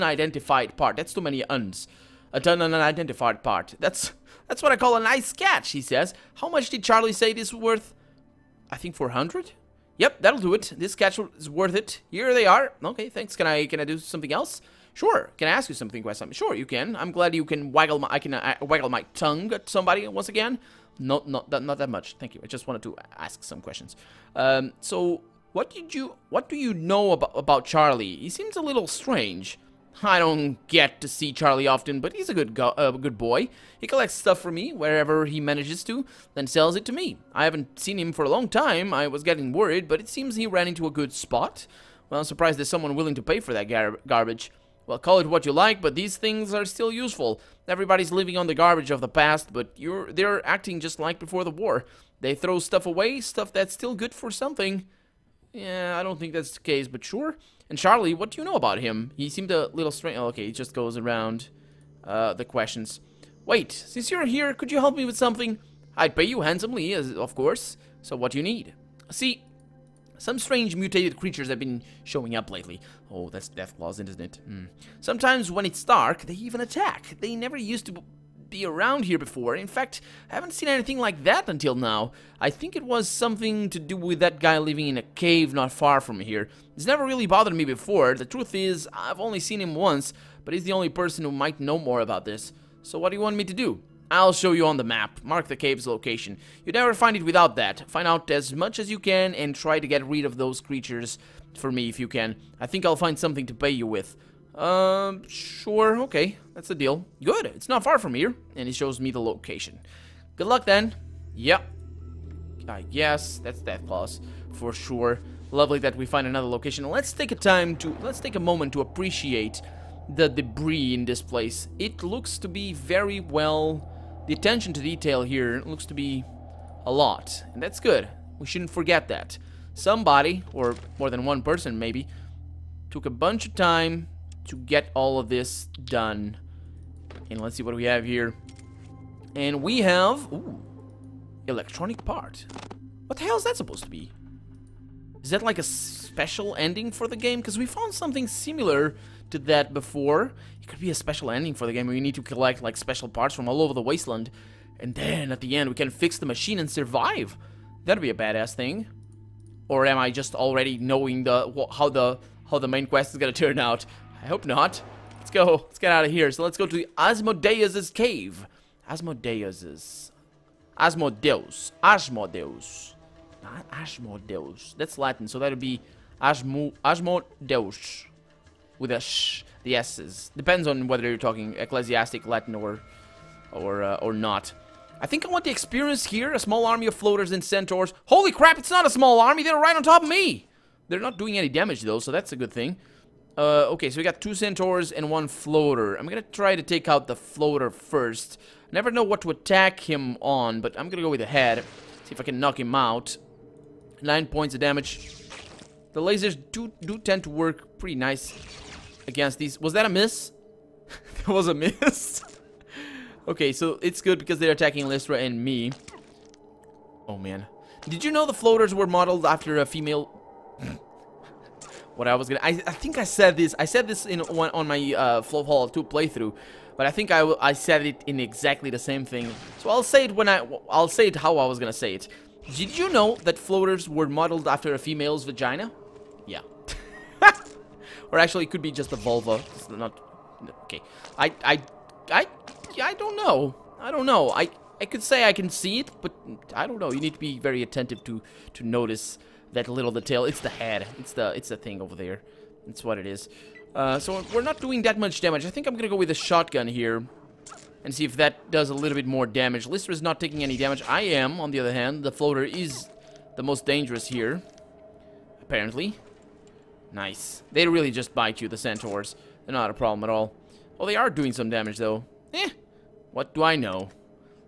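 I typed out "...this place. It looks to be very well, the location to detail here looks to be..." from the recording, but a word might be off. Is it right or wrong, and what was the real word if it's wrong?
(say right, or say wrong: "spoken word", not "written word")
wrong: "attention", not "location".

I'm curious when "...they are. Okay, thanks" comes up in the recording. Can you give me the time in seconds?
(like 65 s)
12 s.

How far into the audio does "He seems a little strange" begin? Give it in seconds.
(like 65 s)
28 s.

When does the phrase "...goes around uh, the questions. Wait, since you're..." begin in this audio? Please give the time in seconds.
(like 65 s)
60 s.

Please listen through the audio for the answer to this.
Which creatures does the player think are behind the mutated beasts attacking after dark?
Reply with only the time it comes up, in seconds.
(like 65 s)
73 s.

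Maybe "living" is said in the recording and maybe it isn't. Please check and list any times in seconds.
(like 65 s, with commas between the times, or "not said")
48 s, 84 s.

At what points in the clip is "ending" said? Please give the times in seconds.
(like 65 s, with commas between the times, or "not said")
146 s, 151 s.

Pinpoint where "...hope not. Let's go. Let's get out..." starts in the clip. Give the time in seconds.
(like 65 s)
164 s.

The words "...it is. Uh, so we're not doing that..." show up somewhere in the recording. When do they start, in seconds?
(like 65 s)
252 s.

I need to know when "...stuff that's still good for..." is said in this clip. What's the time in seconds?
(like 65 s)
53 s.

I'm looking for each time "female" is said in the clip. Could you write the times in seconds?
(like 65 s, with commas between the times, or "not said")
219 s, 234 s.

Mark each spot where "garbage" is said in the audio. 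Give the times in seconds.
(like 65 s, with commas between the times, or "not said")
44 s, 48 s.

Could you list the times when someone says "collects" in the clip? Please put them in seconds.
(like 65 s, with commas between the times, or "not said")
33 s, 152 s.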